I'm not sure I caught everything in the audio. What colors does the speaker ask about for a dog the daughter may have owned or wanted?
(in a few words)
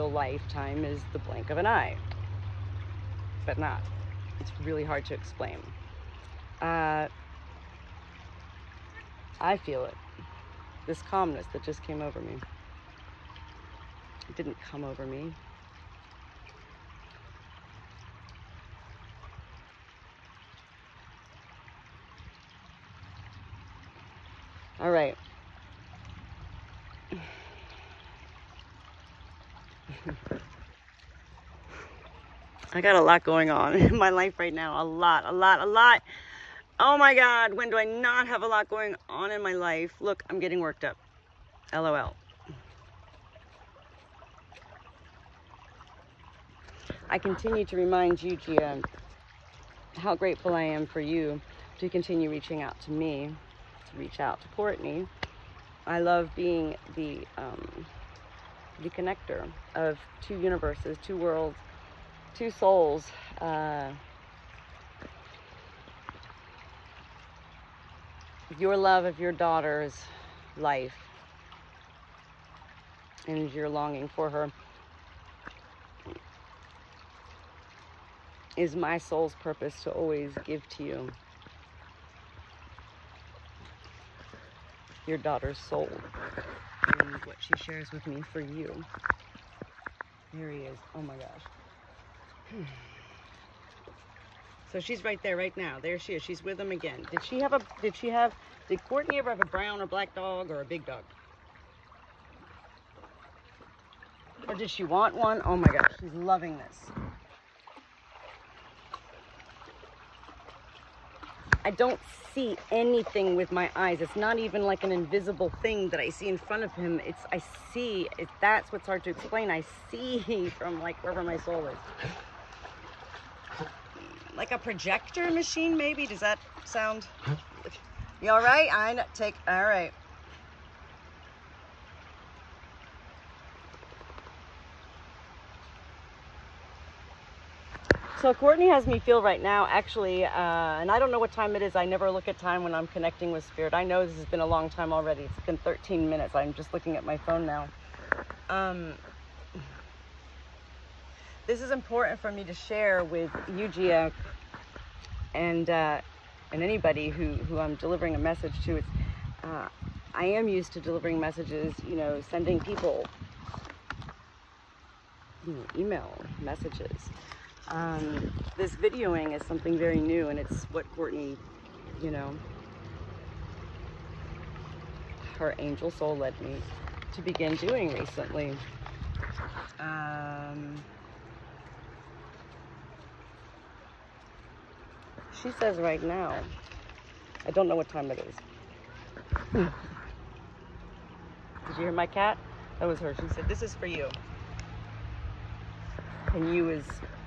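brown or black.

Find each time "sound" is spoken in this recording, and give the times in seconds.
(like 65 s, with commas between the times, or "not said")
126 s.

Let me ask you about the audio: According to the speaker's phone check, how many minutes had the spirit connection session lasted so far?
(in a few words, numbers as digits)
13.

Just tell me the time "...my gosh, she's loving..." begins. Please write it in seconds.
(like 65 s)
105 s.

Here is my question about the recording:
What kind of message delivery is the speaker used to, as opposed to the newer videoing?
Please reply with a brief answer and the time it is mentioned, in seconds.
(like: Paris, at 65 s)
email messages, at 165 s.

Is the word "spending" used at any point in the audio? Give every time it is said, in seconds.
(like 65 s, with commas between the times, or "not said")
not said.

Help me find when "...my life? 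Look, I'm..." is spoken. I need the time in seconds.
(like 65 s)
39 s.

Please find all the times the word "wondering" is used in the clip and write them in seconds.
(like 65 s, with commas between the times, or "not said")
not said.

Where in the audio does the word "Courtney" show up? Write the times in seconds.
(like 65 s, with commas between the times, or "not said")
54 s, 98 s, 138 s, 170 s.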